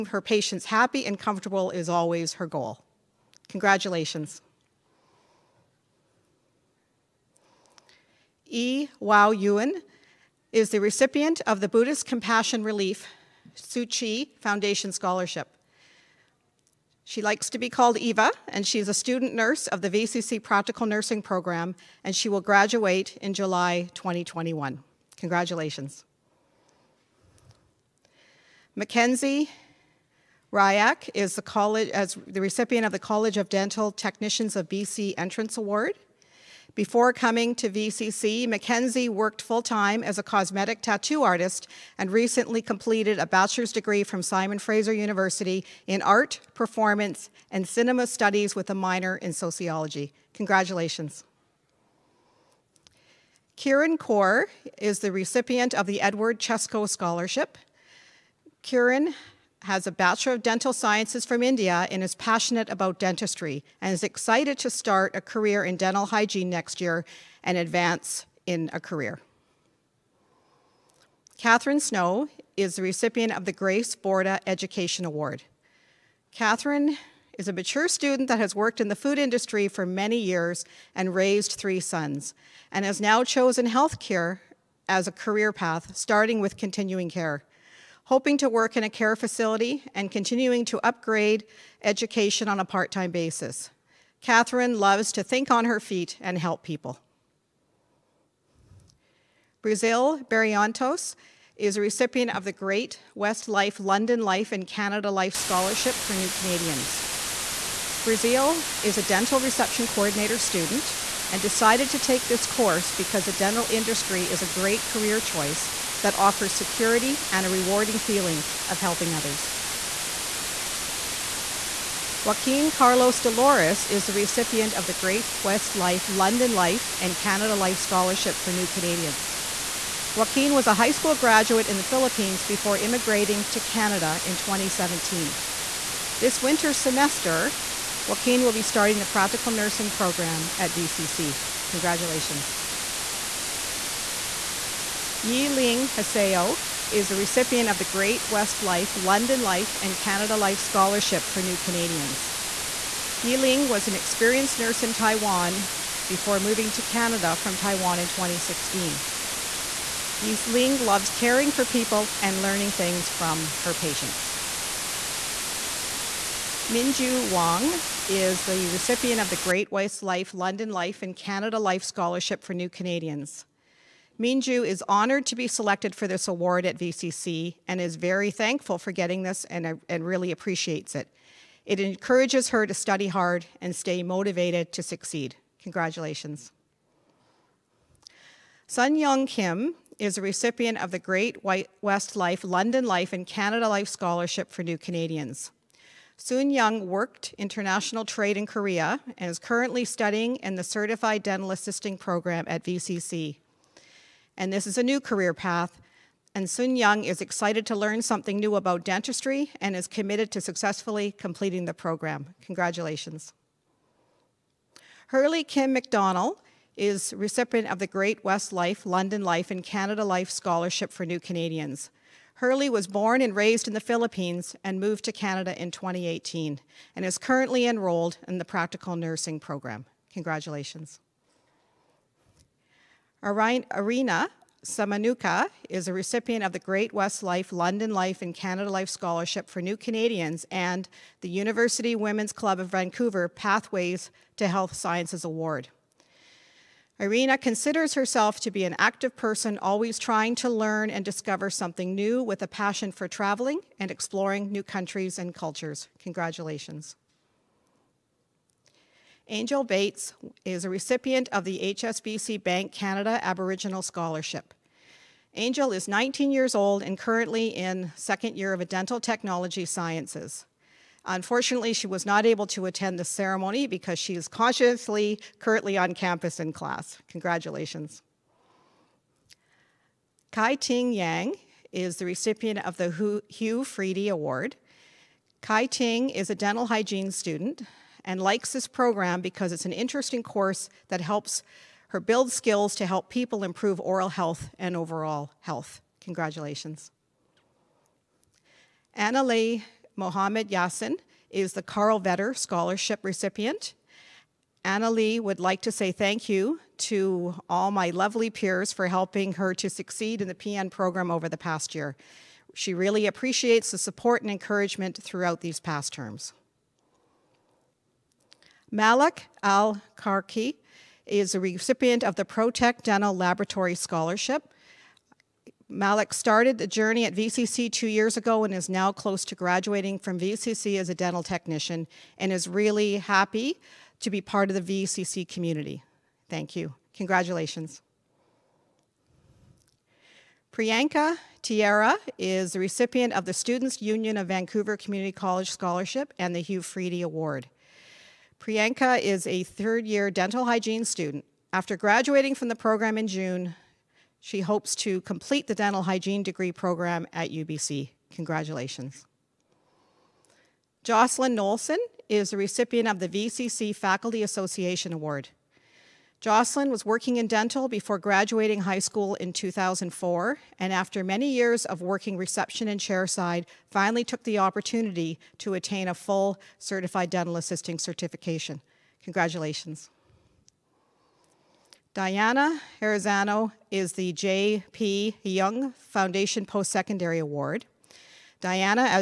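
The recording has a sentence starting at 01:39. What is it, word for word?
Brazil Barrientos is a recipient of the Great West Life London Life and Canada Life Scholarship for New Canadians.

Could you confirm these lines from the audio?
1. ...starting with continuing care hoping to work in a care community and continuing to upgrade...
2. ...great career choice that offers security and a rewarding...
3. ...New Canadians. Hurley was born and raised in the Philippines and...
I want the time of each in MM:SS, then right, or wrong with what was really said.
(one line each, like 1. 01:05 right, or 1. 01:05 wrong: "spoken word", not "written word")
1. 01:25 wrong: "facility", not "community"
2. 01:54 right
3. 03:41 right.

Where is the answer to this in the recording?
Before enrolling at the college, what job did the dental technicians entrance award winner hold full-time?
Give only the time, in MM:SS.
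00:40.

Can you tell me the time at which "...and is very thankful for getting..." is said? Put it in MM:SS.
02:57.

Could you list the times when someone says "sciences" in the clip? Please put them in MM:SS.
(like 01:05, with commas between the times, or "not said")
01:00, 04:04, 04:29.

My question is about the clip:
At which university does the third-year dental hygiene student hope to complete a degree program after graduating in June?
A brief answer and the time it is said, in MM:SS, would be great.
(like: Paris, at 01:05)
UBC, at 05:57.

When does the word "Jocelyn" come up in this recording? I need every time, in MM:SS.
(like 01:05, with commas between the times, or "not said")
06:00, 06:06.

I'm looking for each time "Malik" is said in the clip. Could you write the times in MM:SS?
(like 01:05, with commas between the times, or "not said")
05:18, 05:25.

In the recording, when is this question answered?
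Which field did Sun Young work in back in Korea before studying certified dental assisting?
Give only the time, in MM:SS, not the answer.
03:17.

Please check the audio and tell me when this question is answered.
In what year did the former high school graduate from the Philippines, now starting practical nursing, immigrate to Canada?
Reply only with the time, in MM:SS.
02:14.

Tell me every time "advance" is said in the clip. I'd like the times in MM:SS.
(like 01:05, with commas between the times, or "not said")
01:07.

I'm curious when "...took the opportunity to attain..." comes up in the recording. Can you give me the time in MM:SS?
06:14.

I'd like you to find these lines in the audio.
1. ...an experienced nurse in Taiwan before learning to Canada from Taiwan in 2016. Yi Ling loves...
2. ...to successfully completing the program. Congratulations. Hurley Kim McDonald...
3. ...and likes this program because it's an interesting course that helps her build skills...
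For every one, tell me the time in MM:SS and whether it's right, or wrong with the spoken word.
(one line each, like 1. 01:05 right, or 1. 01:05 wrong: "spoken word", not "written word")
1. 02:33 wrong: "moving", not "learning"
2. 03:30 right
3. 04:48 right.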